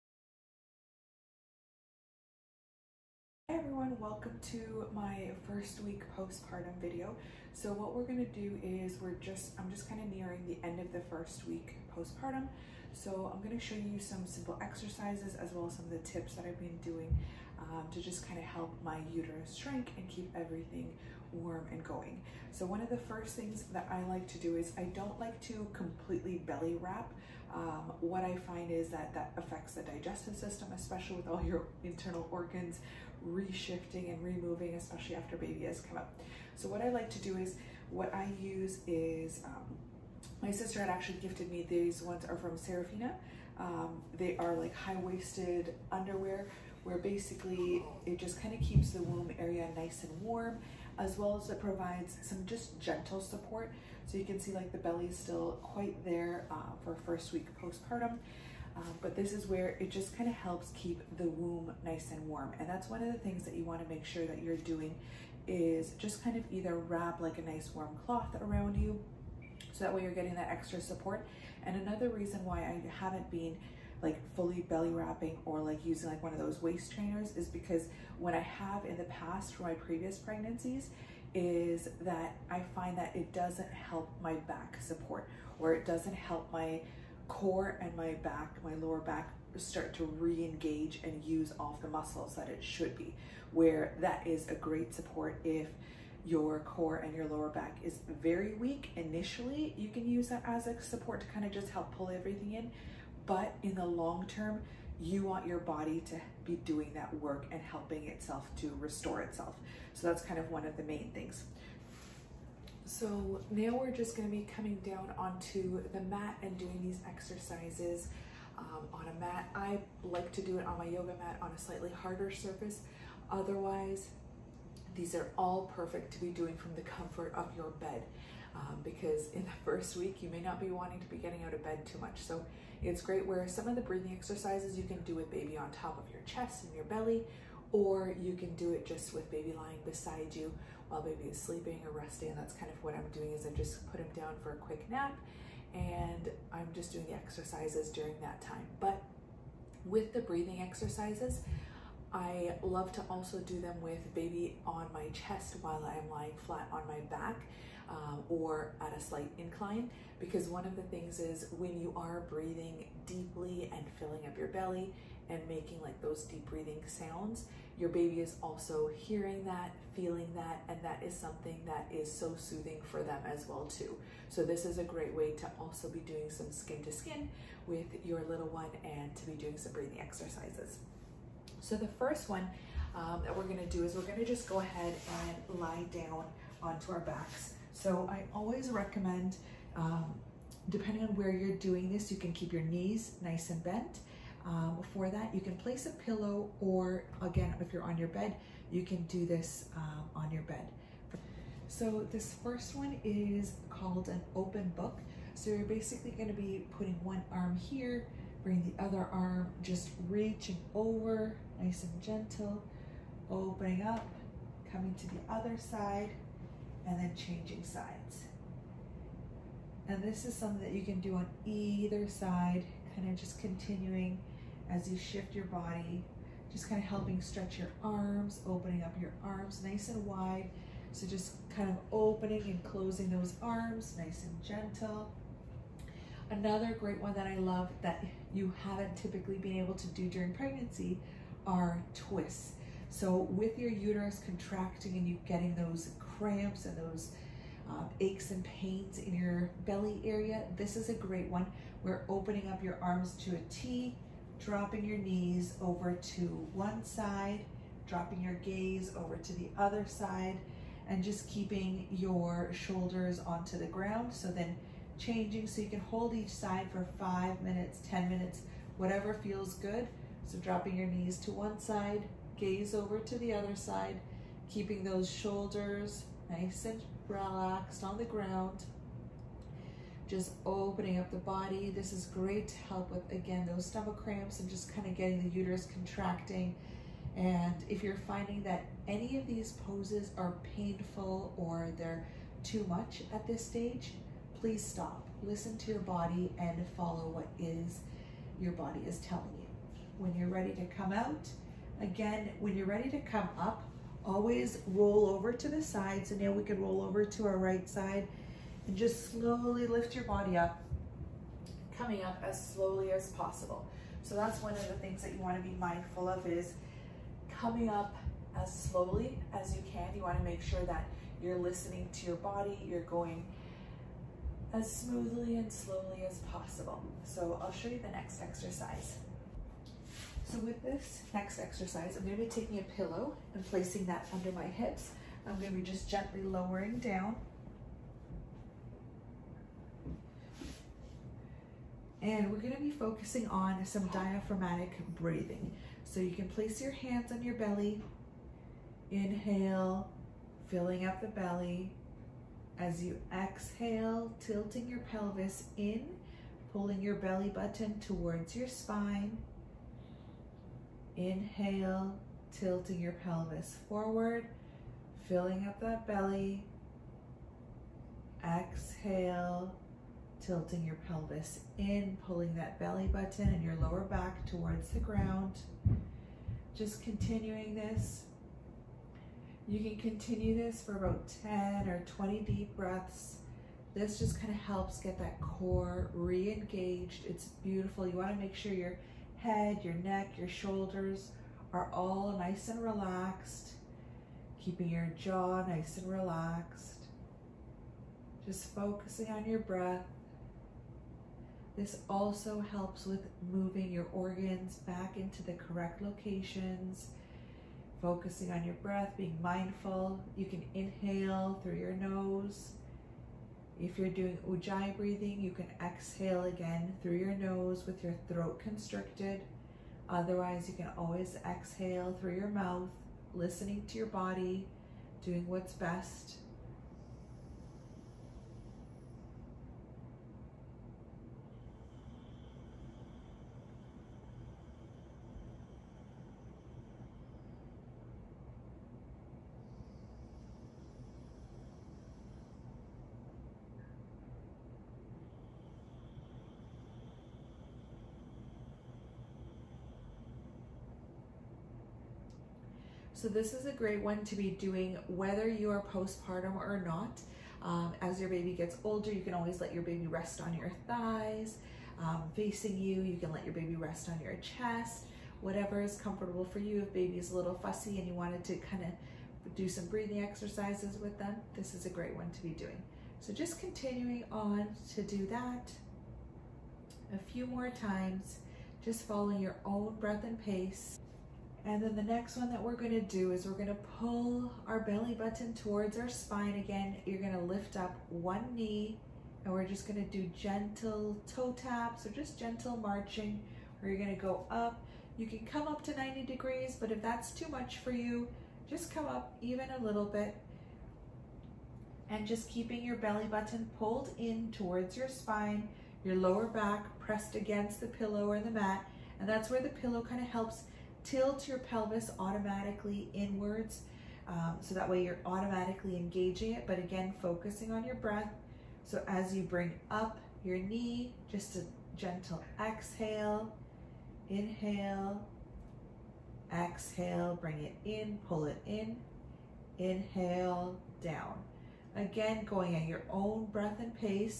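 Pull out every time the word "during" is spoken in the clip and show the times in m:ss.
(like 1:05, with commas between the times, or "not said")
2:27, 4:00.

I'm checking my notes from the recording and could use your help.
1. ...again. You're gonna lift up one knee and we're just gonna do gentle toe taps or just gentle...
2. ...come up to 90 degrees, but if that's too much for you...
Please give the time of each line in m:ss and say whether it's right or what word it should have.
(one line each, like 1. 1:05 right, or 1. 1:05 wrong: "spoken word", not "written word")
1. 8:06 right
2. 8:15 right.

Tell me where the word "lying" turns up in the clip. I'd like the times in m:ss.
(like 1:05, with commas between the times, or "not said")
2:19, 2:36.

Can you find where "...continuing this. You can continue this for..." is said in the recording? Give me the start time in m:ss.
6:16.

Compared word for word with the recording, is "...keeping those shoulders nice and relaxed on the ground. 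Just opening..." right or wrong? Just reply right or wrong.
right.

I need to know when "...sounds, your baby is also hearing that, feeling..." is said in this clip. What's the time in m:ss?
2:46.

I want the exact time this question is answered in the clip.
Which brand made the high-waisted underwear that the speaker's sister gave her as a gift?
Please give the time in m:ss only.
0:42.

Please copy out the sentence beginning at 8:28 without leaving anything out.
And that's where the pillow kind of helps tilt your pelvis automatically inwards.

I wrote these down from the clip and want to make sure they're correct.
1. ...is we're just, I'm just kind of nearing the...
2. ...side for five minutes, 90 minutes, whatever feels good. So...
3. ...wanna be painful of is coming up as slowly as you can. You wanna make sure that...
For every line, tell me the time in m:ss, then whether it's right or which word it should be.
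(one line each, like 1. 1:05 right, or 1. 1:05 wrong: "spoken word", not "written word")
1. 0:08 right
2. 4:26 wrong: "10", not "90"
3. 5:15 wrong: "mindful", not "painful".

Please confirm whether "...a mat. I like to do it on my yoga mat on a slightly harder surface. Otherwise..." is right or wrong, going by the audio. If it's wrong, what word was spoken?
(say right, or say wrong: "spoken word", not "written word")
right.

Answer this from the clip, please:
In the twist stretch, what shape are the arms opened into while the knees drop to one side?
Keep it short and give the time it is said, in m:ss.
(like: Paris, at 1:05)
A T, at 4:13.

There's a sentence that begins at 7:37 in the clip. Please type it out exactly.
Um, as your baby gets older, you can always let your baby rest on your thighs, um, facing you.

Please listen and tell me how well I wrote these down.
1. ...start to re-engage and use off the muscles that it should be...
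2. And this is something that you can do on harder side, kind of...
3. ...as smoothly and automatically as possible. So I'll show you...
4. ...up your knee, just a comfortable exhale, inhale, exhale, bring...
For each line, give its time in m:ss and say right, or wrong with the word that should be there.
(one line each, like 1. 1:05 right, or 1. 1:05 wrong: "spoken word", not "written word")
1. 1:29 right
2. 3:39 wrong: "either", not "harder"
3. 5:24 wrong: "slowly", not "automatically"
4. 8:39 wrong: "gentle", not "comfortable".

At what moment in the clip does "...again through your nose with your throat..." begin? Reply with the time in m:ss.
6:56.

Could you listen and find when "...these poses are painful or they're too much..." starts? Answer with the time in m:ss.
4:49.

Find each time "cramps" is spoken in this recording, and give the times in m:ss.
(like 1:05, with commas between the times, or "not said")
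4:06, 4:44.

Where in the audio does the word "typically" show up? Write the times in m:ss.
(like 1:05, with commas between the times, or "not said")
3:58.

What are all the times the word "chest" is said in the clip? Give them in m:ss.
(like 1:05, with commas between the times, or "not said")
2:16, 2:35, 7:44.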